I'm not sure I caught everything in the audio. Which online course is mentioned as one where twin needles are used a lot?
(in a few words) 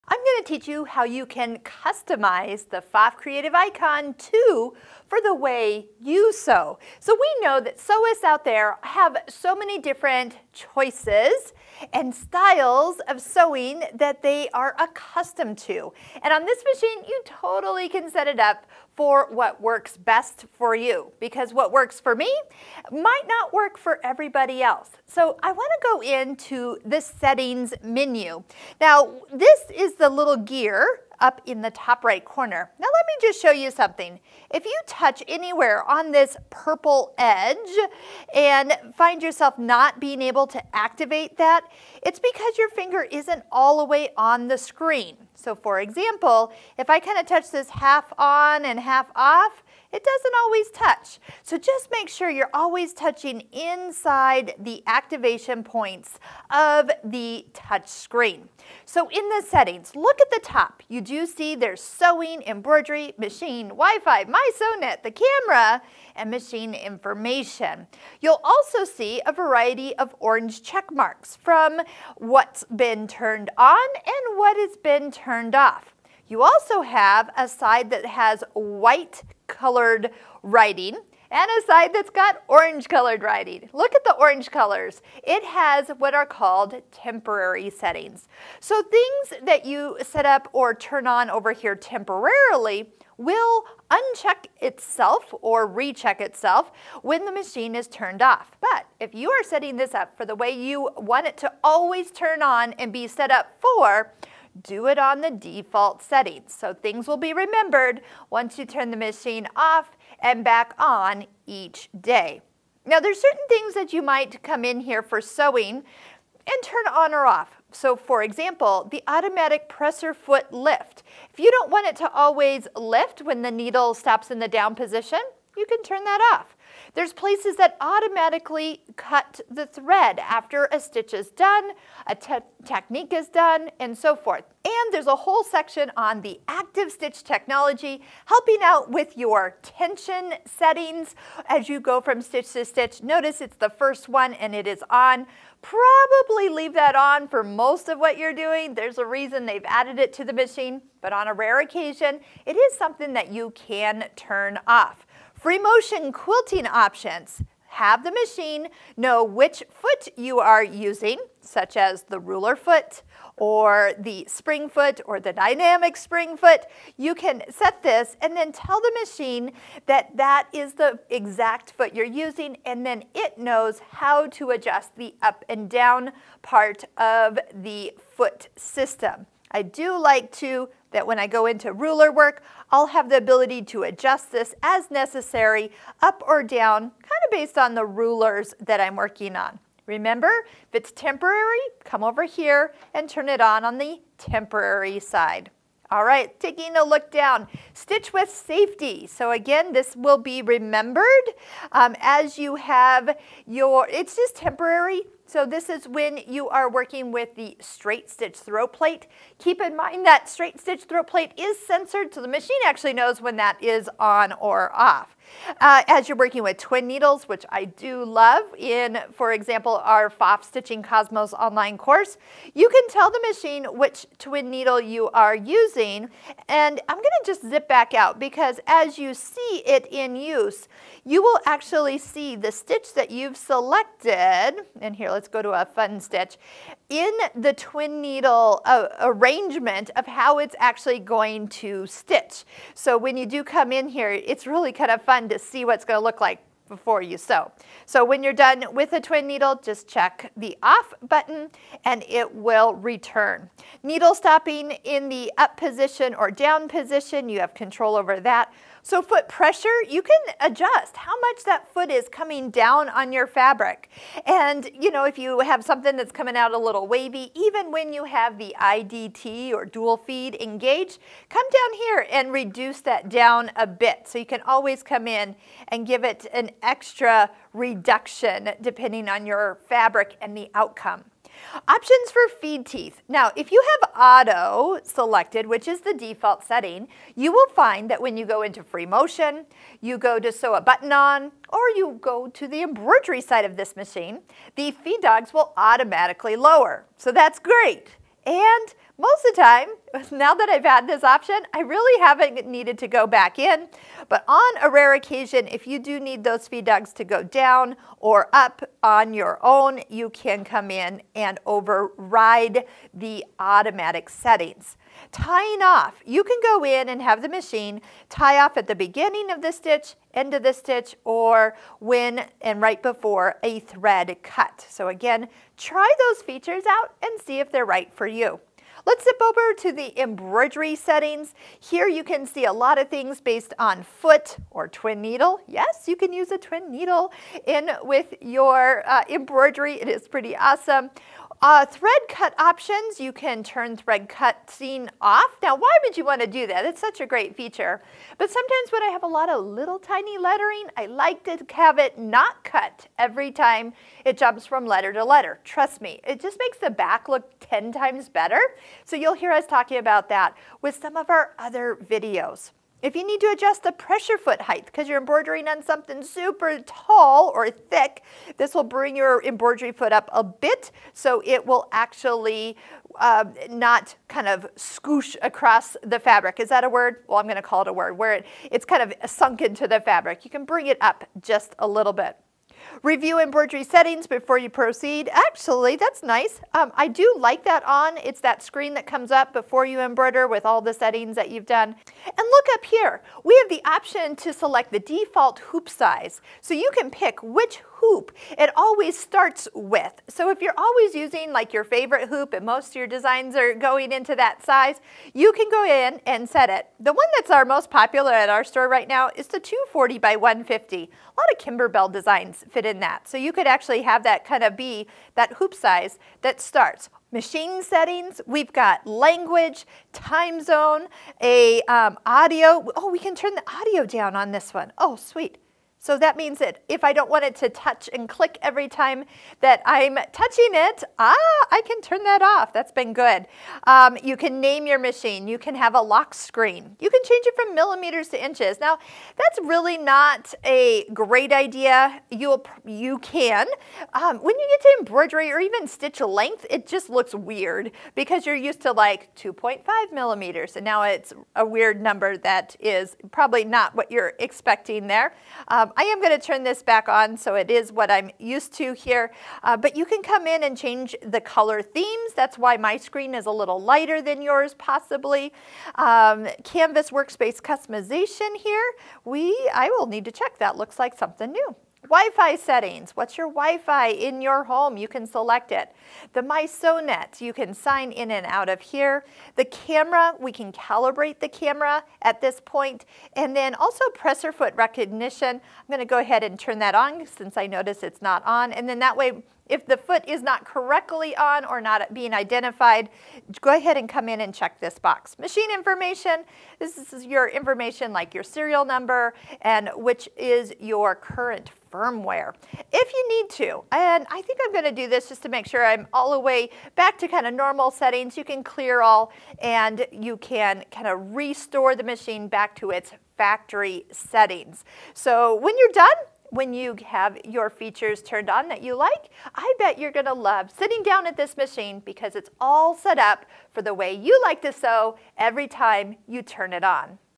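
Pfaff Stitching Cosmos.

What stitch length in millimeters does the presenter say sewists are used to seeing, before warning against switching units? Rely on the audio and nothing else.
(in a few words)
2.5 millimeters.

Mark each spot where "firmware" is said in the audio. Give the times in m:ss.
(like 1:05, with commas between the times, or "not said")
8:21.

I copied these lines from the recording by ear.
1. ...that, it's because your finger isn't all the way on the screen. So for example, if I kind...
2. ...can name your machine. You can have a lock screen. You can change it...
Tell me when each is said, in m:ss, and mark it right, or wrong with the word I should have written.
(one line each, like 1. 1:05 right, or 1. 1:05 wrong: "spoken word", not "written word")
1. 0:41 right
2. 7:14 right.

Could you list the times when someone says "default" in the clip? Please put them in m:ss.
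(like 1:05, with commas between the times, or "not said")
1:45, 4:45, 6:34.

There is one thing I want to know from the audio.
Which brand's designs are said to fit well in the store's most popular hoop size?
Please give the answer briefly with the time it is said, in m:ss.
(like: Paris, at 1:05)
Kimberbell, at 6:51.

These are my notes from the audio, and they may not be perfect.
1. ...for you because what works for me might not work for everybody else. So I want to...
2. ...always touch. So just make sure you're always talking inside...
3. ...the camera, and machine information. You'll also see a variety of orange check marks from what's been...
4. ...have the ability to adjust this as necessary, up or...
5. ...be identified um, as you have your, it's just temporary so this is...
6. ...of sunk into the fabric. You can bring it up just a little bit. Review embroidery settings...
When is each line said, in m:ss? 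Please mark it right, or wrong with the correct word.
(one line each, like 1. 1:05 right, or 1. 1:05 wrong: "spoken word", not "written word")
1. 0:20 right
2. 0:50 wrong: "touching", not "talking"
3. 1:05 right
4. 3:02 right
5. 3:20 wrong: "remembered", not "identified"
6. 6:18 right.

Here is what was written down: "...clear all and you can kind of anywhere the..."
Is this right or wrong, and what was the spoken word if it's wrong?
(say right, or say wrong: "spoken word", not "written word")
wrong: "restore", not "anywhere".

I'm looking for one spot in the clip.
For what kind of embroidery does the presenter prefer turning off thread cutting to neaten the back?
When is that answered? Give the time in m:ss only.
5:49.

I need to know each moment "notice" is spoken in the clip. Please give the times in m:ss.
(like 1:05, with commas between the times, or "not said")
2:23, 8:07.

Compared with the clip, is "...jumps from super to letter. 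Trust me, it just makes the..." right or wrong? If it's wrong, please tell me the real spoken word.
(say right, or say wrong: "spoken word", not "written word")
wrong: "letter", not "super".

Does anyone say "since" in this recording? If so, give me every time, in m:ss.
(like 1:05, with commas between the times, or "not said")
8:07.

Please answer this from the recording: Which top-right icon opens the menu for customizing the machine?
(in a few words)
Gear.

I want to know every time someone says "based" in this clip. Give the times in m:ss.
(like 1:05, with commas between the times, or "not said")
3:07, 5:33.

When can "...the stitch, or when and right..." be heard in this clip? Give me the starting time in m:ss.
5:20.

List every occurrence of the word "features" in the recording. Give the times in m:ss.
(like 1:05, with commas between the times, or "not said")
5:26, 5:47, 8:37.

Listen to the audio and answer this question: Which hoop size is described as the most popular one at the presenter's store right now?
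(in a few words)
240 by 150.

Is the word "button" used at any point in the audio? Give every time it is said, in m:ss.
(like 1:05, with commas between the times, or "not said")
4:11, 4:50.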